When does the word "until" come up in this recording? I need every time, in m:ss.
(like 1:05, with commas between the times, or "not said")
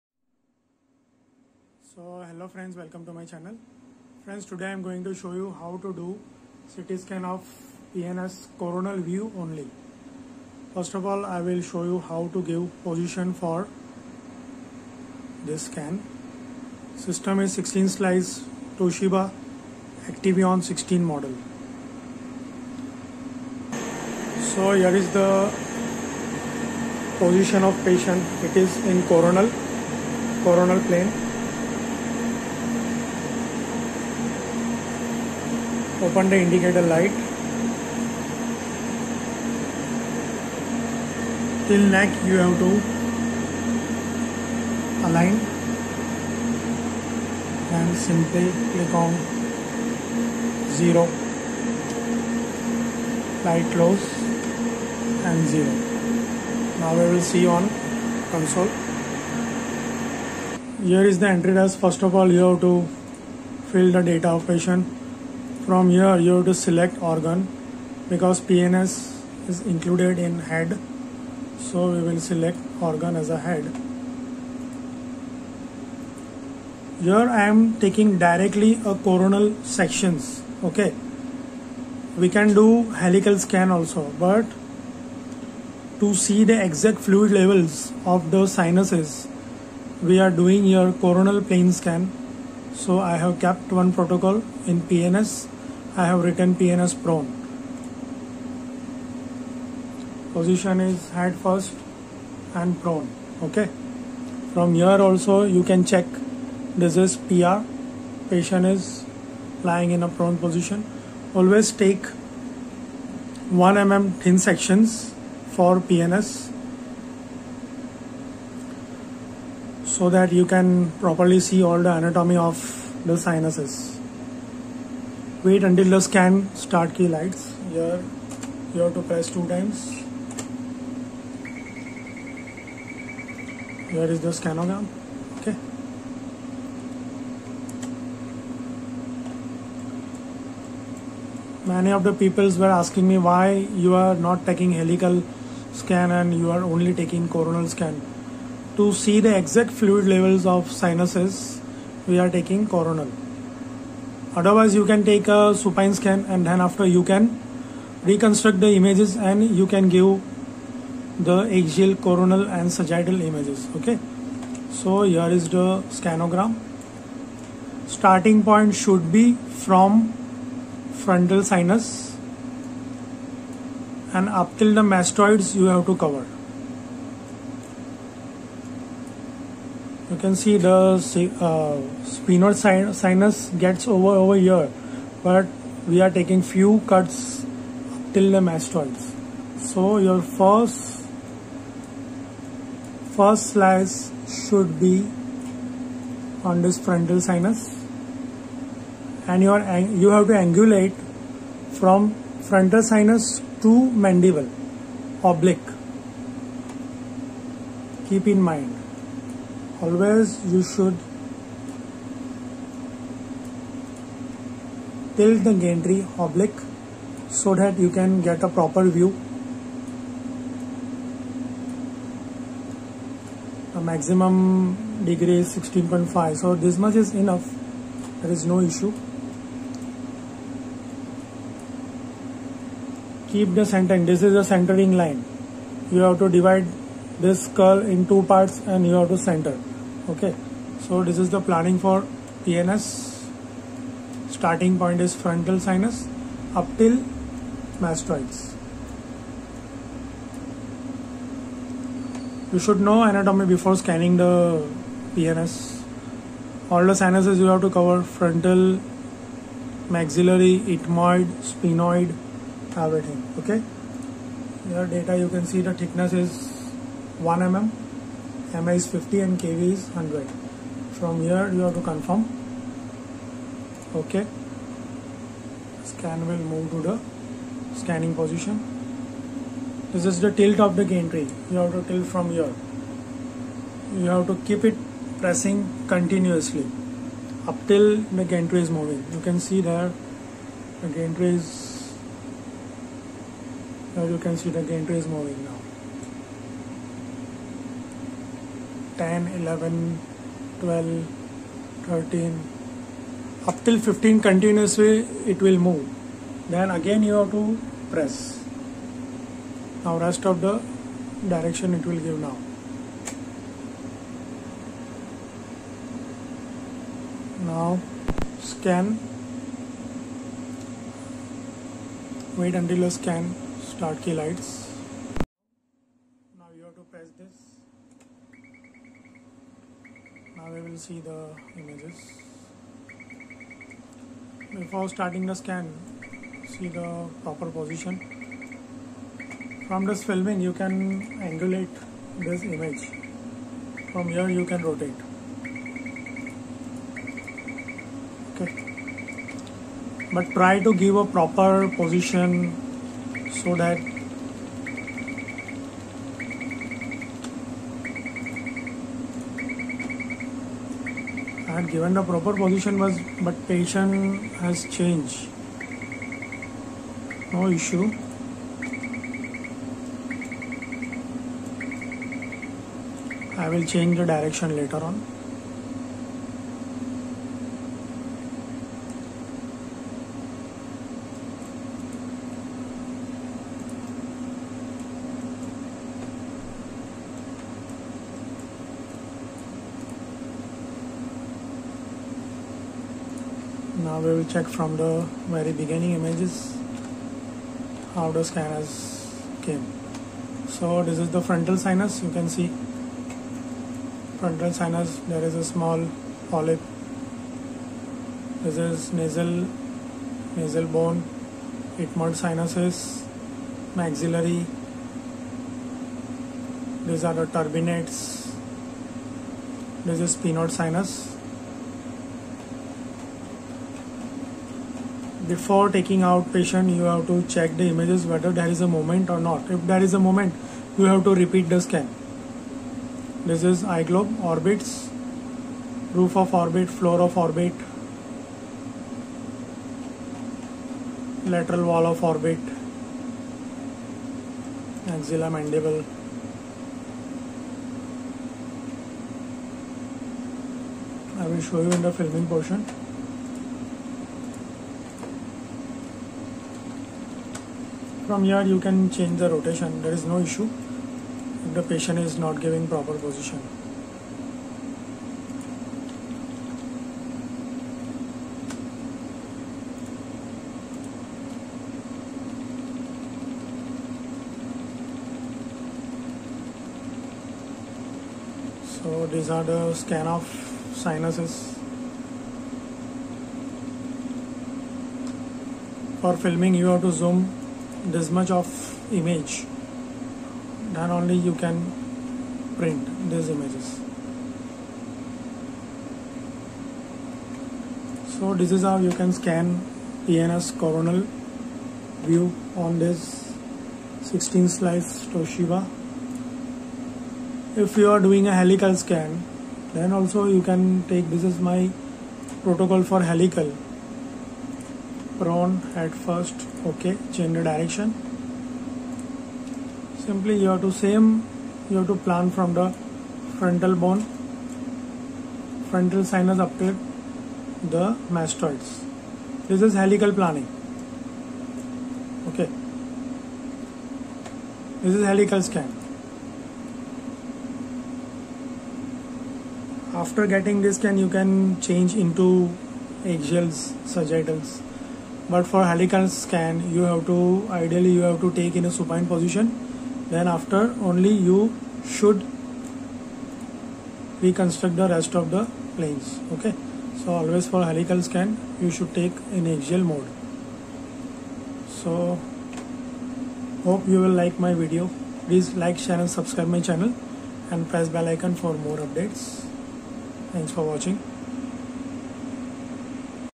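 2:05, 5:22.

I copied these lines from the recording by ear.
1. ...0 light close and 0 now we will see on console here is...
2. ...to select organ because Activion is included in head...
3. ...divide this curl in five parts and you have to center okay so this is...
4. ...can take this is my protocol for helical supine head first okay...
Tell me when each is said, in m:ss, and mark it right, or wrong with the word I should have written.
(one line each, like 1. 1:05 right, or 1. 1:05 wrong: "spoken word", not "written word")
1. 0:50 right
2. 1:06 wrong: "PNS", not "Activion"
3. 3:56 wrong: "two", not "five"
4. 8:30 wrong: "prone", not "supine".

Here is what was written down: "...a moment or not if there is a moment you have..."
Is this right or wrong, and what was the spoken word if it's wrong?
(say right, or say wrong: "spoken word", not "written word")
right.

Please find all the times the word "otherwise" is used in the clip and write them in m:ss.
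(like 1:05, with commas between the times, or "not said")
2:34.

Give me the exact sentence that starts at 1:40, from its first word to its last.
Position is head first and prone.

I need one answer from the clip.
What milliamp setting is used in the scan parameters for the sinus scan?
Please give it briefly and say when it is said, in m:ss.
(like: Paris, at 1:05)
50, at 4:28.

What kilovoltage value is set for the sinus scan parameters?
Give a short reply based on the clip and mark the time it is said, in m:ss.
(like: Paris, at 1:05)
100, at 4:29.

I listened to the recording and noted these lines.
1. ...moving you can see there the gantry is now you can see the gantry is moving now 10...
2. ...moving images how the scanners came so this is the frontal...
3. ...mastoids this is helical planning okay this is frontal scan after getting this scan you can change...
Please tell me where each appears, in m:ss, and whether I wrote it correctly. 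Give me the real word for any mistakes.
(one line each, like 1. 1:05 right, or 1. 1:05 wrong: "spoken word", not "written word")
1. 4:48 right
2. 6:35 wrong: "beginning", not "moving"
3. 8:48 wrong: "helical", not "frontal".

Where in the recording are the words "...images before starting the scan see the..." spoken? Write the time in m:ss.
5:31.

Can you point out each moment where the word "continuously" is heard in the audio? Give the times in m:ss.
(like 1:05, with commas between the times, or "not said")
4:45, 5:04.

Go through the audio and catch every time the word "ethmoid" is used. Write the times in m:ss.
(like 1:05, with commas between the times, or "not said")
4:20.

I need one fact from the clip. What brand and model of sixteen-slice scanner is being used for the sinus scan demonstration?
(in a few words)
Toshiba Activion 16.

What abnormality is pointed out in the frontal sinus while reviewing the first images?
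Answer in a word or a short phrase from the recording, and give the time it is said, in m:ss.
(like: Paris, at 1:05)
small polyp, at 6:45.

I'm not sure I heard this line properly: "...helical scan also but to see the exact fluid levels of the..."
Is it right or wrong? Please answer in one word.
right.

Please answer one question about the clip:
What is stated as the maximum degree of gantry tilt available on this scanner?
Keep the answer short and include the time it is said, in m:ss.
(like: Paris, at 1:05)
16.5, at 3:45.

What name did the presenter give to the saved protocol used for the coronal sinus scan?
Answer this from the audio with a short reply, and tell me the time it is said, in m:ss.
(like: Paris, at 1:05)
PNS prone, at 1:36.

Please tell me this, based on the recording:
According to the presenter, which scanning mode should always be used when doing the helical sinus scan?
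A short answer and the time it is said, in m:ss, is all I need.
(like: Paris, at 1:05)
axial mode, at 9:19.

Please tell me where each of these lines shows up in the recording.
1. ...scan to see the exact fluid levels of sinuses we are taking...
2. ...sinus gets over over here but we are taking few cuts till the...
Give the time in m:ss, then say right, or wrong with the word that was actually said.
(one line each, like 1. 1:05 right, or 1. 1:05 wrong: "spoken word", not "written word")
1. 2:27 right
2. 3:03 right.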